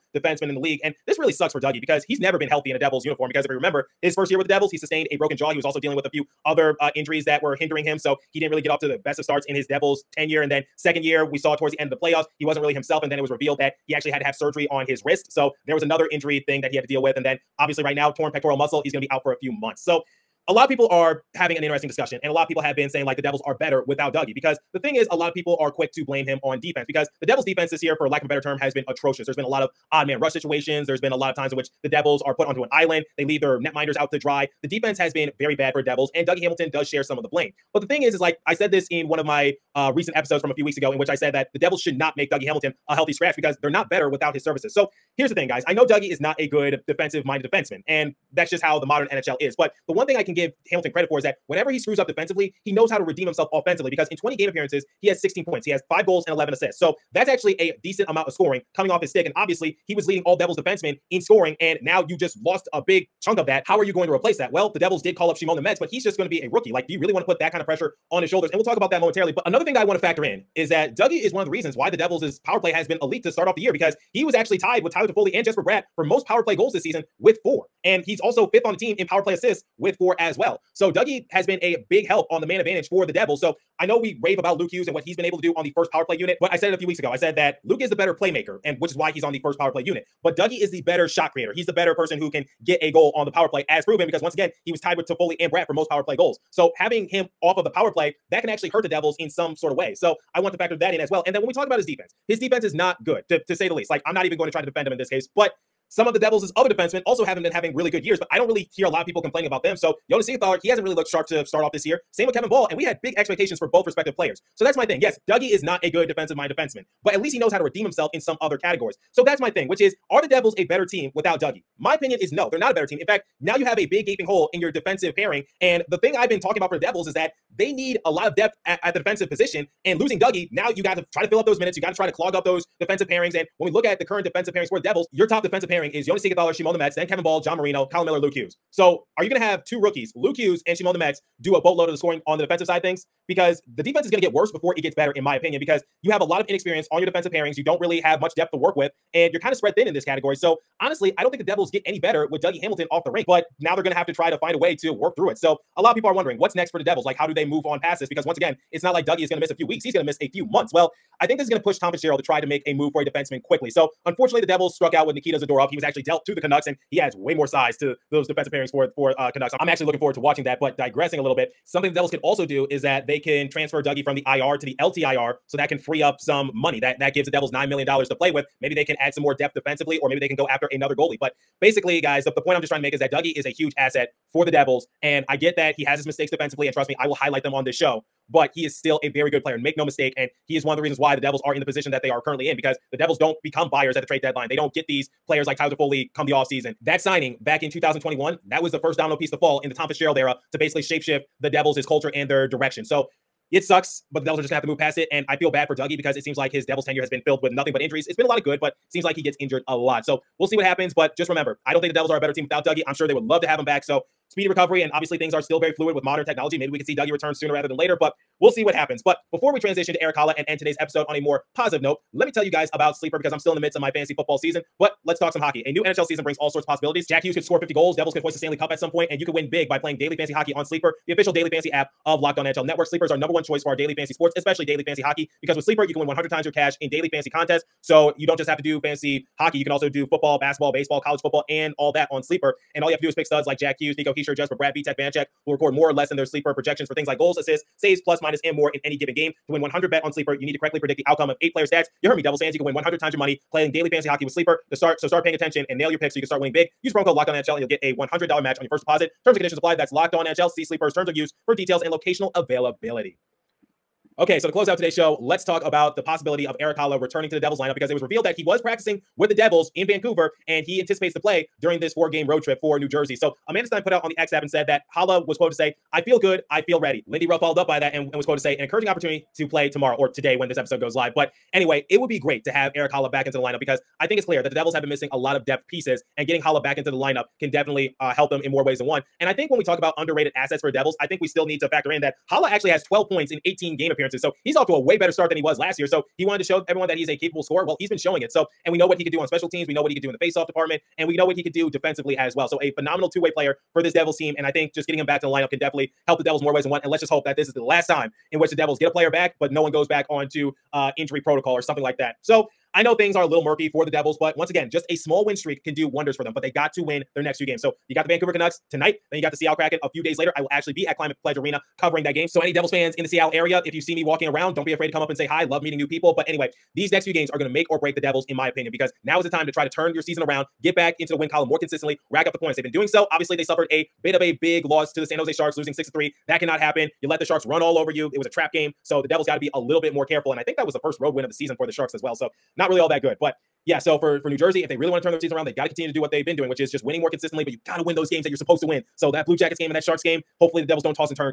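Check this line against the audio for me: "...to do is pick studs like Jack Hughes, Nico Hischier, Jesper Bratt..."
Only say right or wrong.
right.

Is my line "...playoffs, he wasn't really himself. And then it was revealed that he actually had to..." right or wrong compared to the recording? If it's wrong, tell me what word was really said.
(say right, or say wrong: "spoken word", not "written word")
right.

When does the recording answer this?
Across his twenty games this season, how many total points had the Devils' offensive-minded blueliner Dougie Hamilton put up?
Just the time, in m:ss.
0:55.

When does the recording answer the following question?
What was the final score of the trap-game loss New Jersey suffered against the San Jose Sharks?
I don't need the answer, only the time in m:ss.
5:35.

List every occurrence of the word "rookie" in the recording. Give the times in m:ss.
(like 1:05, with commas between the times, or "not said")
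1:06, 2:19.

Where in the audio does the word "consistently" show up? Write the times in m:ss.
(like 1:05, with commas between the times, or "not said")
5:31, 5:47.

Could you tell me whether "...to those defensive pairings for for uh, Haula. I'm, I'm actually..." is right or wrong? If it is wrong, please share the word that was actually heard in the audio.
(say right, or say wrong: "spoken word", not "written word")
wrong: "Canucks", not "Haula".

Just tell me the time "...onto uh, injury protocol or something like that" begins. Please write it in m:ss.
5:10.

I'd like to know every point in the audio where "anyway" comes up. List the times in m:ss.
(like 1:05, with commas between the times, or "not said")
4:41, 5:26.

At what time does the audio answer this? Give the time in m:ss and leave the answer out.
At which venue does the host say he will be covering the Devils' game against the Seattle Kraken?
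5:20.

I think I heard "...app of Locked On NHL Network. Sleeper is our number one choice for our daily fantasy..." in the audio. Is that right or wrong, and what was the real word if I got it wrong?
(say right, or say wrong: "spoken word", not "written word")
right.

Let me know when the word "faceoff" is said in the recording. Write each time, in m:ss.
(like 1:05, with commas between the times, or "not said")
5:00.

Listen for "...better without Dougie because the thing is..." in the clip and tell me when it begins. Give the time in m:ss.
0:23.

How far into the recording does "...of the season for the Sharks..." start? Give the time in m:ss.
5:41.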